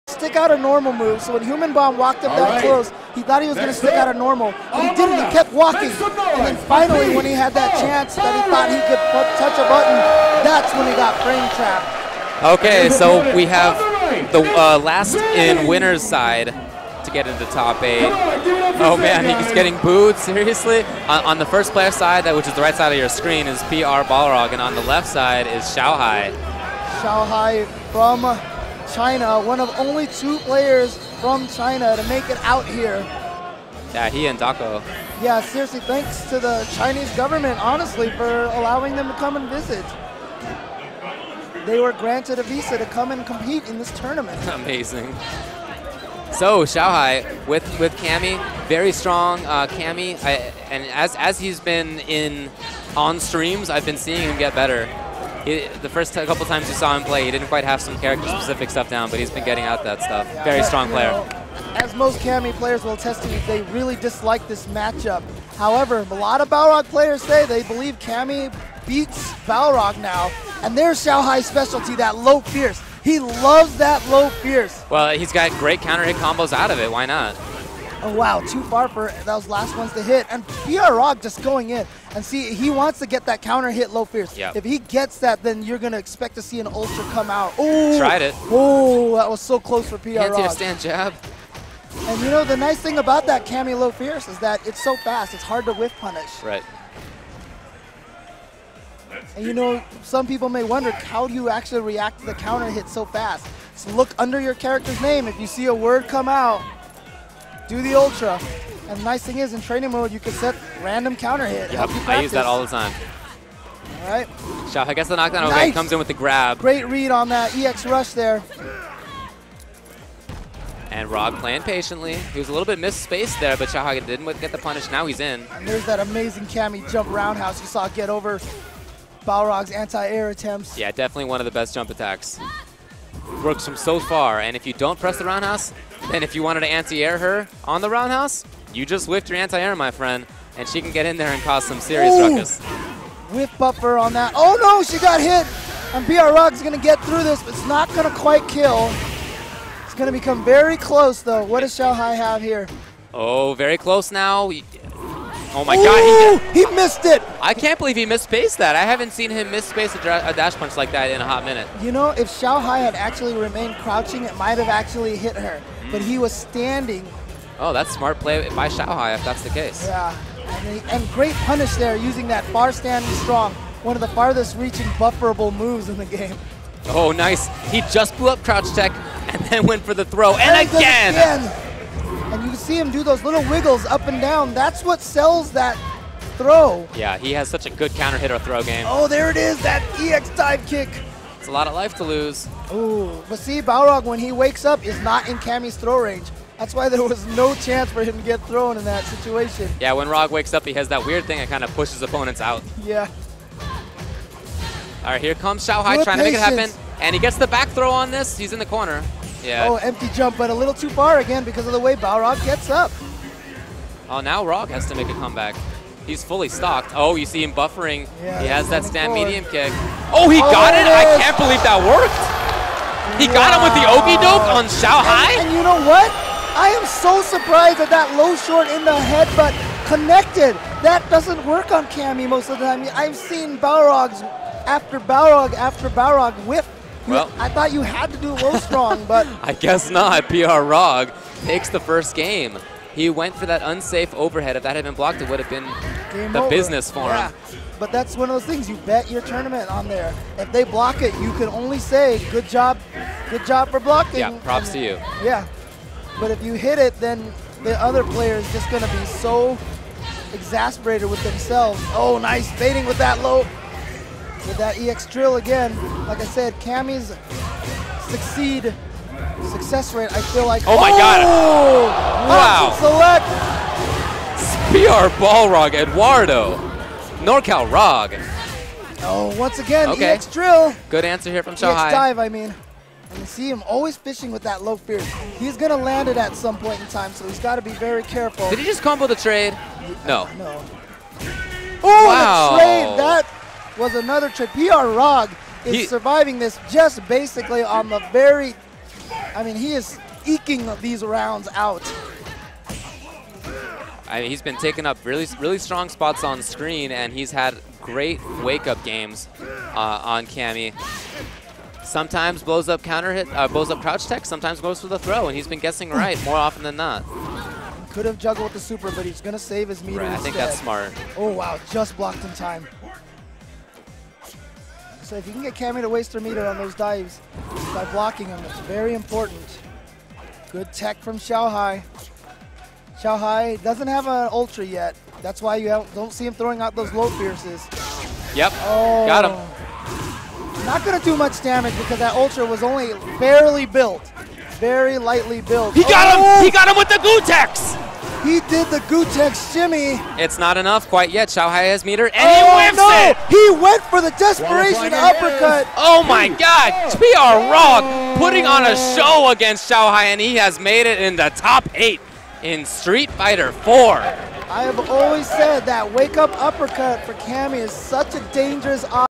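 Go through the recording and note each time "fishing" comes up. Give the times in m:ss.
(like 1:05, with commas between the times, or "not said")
4:43.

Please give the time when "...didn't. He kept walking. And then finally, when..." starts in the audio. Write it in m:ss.
0:04.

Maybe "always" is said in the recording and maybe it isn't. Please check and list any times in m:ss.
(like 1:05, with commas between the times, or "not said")
4:43, 6:04.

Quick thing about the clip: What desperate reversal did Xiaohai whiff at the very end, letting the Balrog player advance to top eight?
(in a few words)
desperation uppercut.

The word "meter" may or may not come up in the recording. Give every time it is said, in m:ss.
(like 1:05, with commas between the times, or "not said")
5:19, 5:26, 5:51.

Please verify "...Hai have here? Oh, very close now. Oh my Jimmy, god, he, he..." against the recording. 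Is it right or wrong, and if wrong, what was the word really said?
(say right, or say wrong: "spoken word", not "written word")
wrong: "Ooh", not "Jimmy".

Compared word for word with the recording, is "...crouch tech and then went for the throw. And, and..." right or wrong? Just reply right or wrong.
right.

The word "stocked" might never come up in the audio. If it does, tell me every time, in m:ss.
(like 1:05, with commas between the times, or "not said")
3:36.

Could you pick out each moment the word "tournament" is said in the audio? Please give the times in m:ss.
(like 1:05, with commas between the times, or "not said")
0:43, 4:09.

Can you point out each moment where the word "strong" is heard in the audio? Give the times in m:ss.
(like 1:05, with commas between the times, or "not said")
0:48, 1:00, 2:53, 3:58, 5:05.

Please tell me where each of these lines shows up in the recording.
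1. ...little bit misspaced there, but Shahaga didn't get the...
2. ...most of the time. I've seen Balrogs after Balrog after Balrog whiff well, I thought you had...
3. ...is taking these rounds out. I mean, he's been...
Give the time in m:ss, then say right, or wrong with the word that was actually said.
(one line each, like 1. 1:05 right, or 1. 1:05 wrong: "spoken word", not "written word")
1. 2:02 right
2. 3:52 right
3. 4:59 wrong: "eking", not "taking".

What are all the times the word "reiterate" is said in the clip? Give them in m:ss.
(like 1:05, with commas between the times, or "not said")
not said.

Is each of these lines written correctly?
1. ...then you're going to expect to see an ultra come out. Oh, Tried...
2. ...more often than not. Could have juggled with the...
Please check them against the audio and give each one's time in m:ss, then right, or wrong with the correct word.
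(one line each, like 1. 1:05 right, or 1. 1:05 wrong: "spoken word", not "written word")
1. 1:25 right
2. 5:16 right.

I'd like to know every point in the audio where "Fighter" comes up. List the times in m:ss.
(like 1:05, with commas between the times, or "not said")
6:03.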